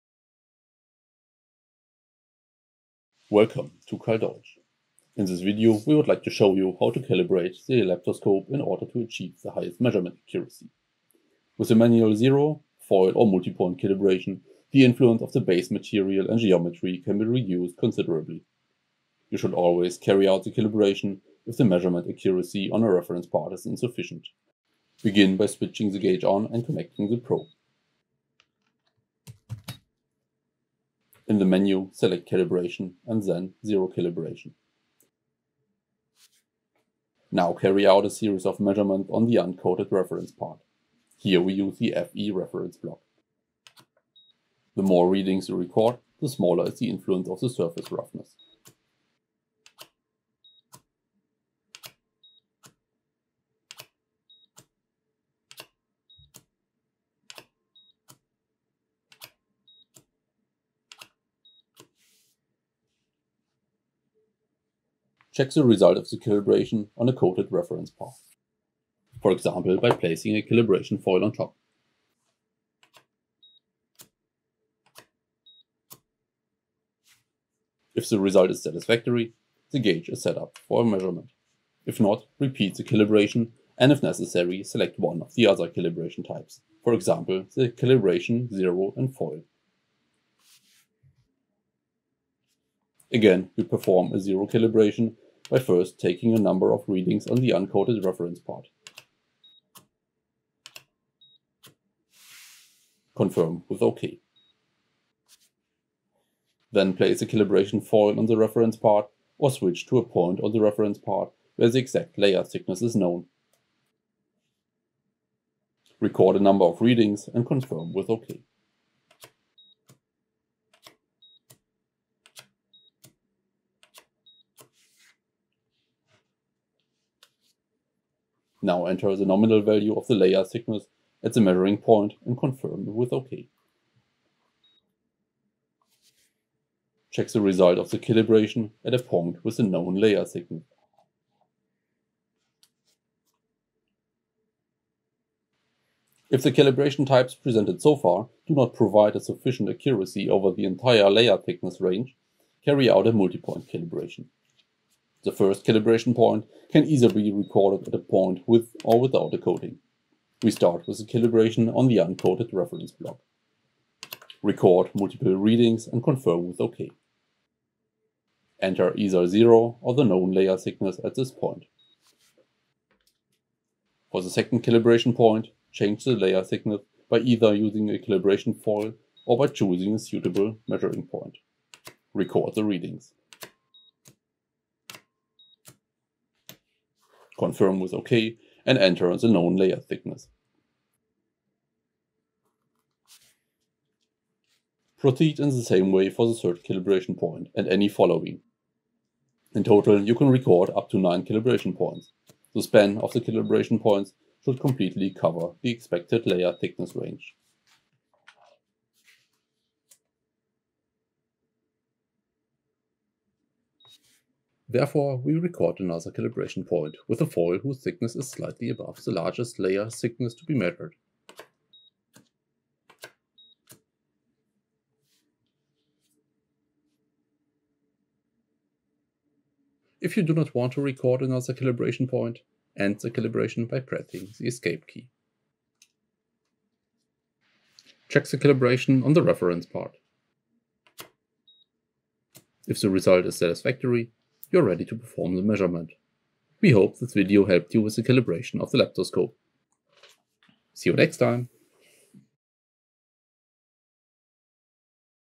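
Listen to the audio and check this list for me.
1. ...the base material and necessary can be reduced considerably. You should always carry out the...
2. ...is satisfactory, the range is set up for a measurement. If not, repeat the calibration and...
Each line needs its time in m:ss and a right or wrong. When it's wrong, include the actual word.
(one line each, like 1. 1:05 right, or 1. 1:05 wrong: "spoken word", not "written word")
1. 0:15 wrong: "geometry", not "necessary"
2. 1:18 wrong: "gauge", not "range".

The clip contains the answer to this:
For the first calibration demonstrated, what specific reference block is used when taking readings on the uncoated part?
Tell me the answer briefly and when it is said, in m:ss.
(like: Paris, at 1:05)
FE reference block, at 0:42.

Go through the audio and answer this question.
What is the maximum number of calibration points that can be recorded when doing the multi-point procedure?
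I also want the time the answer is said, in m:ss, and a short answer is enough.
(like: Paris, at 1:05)
9, at 3:20.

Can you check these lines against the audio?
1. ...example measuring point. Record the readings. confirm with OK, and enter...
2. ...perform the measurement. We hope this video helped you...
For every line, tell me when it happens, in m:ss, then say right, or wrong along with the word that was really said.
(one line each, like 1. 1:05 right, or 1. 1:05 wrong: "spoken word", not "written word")
1. 2:59 wrong: "suitable", not "example"
2. 4:04 right.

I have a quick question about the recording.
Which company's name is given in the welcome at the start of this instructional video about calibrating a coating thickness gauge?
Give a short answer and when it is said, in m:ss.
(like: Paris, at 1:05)
Karl Deutsch, at 0:03.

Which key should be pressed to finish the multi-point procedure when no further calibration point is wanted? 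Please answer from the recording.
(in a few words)
escape key.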